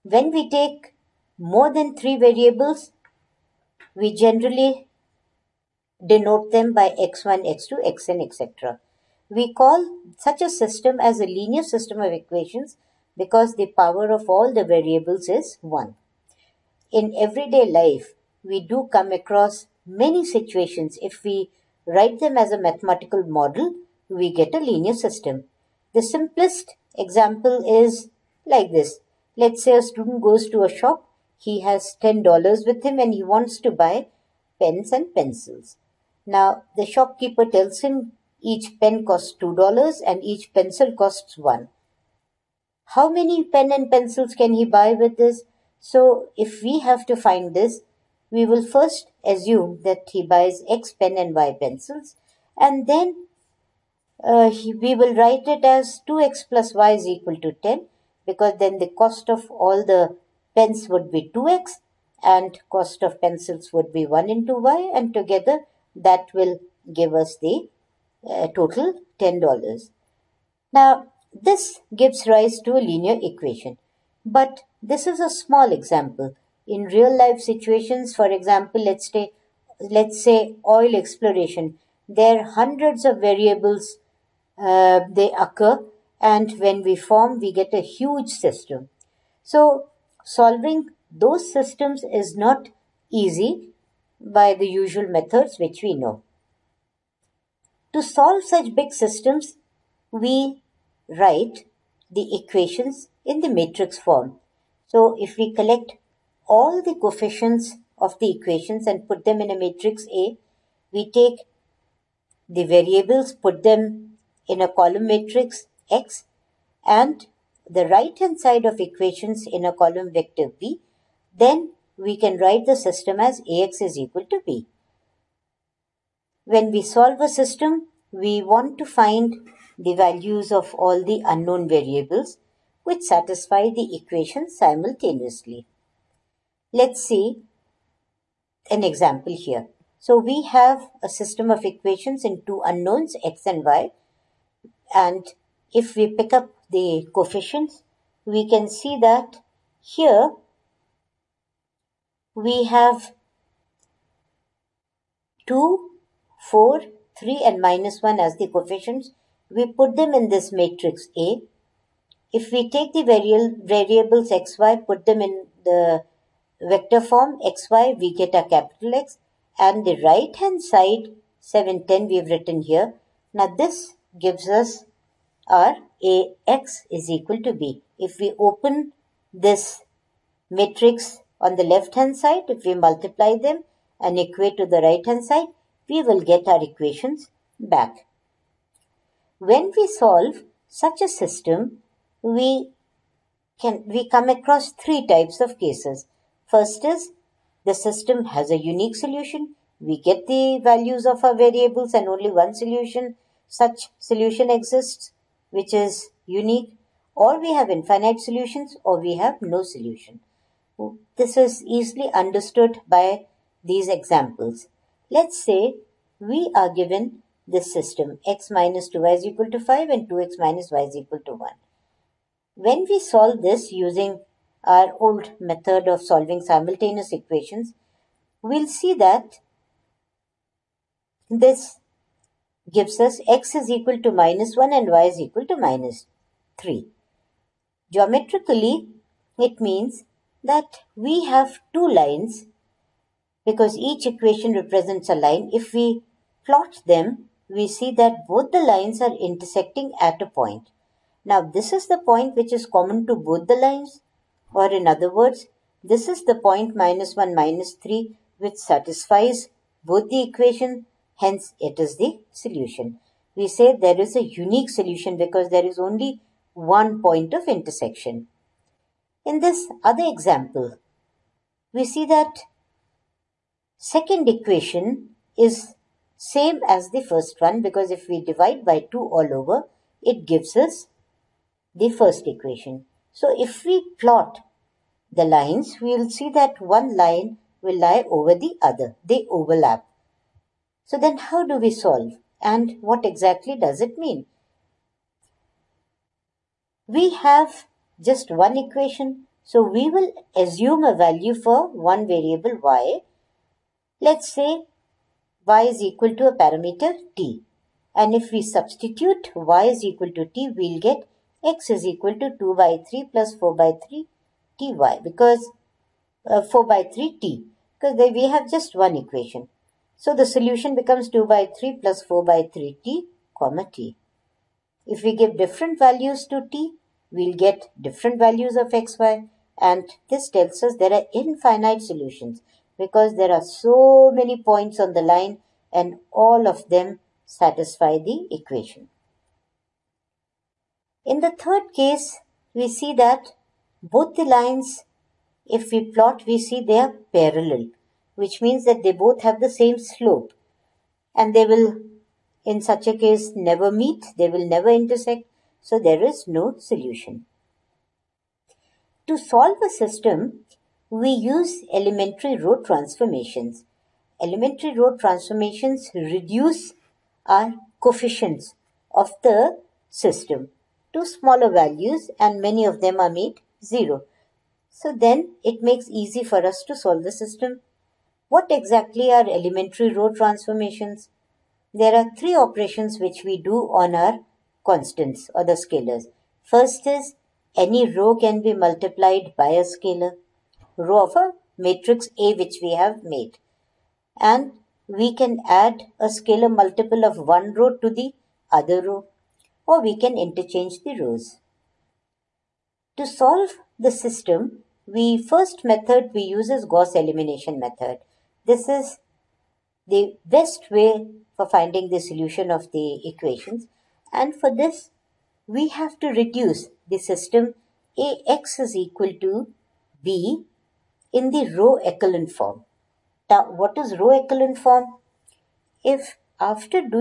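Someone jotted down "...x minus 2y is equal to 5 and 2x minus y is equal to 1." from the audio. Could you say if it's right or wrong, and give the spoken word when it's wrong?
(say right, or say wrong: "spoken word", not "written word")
right.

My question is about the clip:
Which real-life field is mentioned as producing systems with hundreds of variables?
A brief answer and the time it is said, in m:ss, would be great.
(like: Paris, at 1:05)
Oil exploration, at 1:20.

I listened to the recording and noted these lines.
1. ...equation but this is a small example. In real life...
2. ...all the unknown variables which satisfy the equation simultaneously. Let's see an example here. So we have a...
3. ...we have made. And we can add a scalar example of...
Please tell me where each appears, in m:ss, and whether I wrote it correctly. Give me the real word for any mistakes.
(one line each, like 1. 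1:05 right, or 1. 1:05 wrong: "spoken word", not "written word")
1. 1:13 right
2. 2:10 right
3. 6:32 wrong: "multiple", not "example".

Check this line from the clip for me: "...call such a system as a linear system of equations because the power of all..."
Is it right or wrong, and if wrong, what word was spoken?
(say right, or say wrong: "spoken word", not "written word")
right.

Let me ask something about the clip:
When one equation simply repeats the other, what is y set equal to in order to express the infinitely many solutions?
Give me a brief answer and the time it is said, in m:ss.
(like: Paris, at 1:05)
a parameter t, at 5:06.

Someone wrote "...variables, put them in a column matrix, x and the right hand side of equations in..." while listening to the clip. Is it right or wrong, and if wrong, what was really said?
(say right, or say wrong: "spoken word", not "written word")
right.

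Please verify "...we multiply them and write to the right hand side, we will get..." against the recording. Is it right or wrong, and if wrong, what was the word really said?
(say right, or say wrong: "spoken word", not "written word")
wrong: "equate", not "write".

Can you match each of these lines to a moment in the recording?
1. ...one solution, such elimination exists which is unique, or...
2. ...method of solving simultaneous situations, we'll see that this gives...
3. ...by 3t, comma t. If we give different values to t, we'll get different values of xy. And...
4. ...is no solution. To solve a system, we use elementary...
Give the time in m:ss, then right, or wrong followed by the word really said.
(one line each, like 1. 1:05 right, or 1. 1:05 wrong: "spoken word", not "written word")
1. 3:22 wrong: "solution", not "elimination"
2. 3:45 wrong: "equations", not "situations"
3. 5:22 right
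4. 5:56 right.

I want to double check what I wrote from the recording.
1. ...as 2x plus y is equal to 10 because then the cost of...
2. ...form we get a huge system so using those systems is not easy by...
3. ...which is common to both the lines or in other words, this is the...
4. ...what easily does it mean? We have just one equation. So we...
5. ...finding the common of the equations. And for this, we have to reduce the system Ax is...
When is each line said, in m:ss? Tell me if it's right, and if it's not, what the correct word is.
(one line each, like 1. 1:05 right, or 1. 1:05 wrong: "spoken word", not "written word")
1. 0:55 right
2. 1:26 wrong: "solving", not "using"
3. 4:12 right
4. 4:52 wrong: "exactly", not "easily"
5. 6:51 wrong: "solution", not "common".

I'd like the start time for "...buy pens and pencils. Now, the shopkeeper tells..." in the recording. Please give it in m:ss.
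0:33.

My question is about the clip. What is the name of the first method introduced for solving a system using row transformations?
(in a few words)
Gauss elimination method.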